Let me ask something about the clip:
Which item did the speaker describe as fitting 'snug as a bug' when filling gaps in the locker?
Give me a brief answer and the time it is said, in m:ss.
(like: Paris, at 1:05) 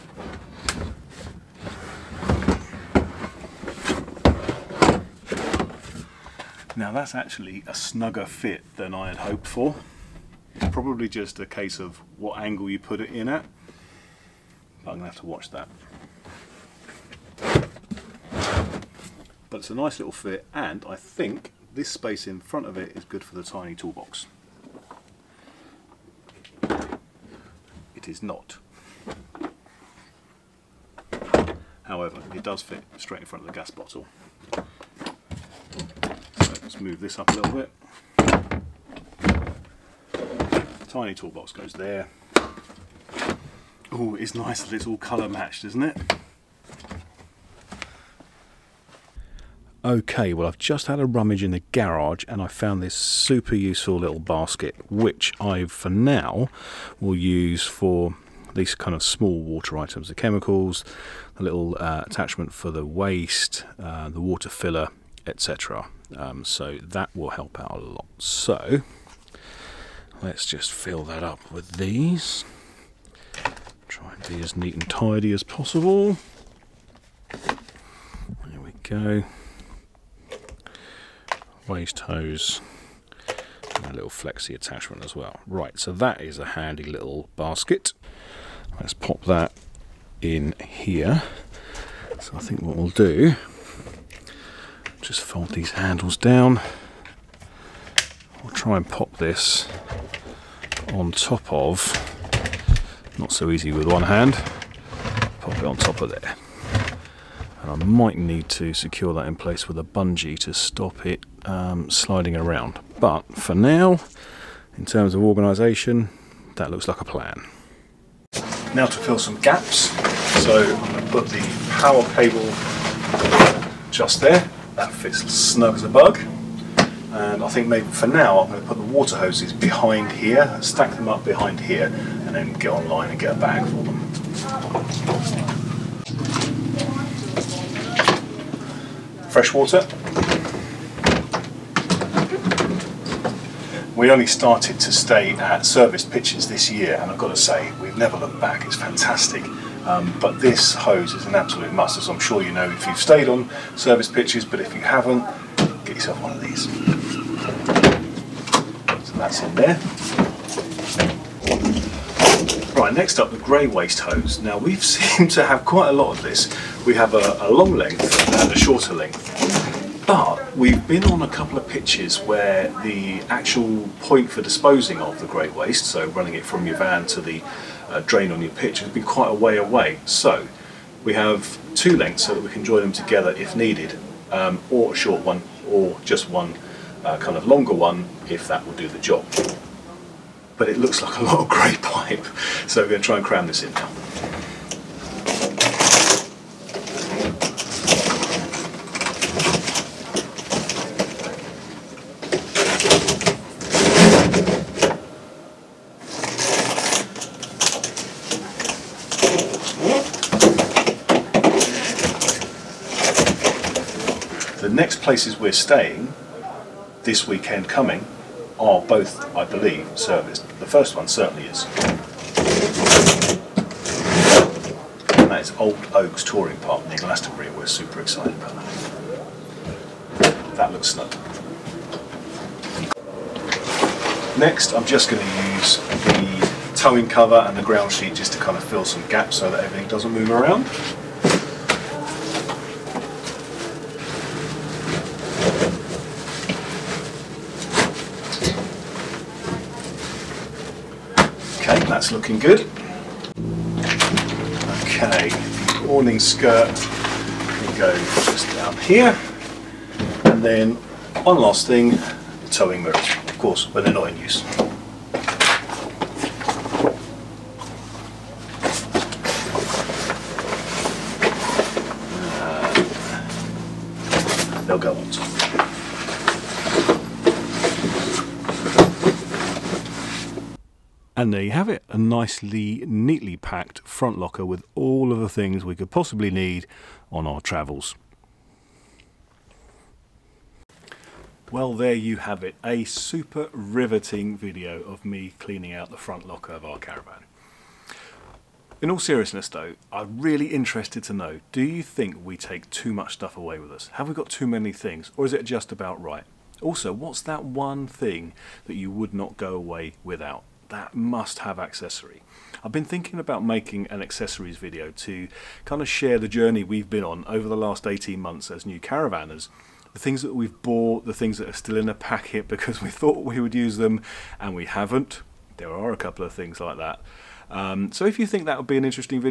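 power cable, at 2:01.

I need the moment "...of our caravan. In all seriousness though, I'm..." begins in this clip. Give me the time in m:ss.
4:56.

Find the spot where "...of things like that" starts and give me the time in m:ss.
5:26.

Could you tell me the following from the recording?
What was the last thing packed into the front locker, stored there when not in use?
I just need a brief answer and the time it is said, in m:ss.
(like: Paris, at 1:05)
towing mirrors, at 4:22.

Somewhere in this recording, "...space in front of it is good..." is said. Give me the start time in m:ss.
0:21.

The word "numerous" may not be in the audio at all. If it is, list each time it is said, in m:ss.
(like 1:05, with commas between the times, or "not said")
not said.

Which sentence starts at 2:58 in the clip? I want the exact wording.
It'll be quite a way away.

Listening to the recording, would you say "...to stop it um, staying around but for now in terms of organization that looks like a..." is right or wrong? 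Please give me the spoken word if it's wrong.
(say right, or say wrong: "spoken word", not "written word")
wrong: "sliding", not "staying".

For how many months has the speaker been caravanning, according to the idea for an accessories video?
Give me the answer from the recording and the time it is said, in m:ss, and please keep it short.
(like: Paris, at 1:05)
18, at 5:17.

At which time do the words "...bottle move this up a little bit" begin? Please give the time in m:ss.
0:33.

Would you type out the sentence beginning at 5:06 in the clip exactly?
Also, what's that one thing that you would not go away without?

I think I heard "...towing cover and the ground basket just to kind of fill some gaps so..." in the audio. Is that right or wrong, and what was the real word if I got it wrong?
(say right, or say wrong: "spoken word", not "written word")
wrong: "sheet", not "basket".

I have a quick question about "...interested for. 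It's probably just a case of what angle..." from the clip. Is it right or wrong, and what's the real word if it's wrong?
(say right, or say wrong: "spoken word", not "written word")
wrong: "hoped", not "interested".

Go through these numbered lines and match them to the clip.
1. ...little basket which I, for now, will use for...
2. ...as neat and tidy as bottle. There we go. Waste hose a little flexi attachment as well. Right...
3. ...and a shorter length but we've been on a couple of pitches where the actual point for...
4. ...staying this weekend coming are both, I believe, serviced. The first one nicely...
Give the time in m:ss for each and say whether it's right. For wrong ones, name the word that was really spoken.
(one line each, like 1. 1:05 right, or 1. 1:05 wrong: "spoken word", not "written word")
1. 0:53 right
2. 1:14 wrong: "possible", not "bottle"
3. 2:48 right
4. 3:35 wrong: "certainly", not "nicely".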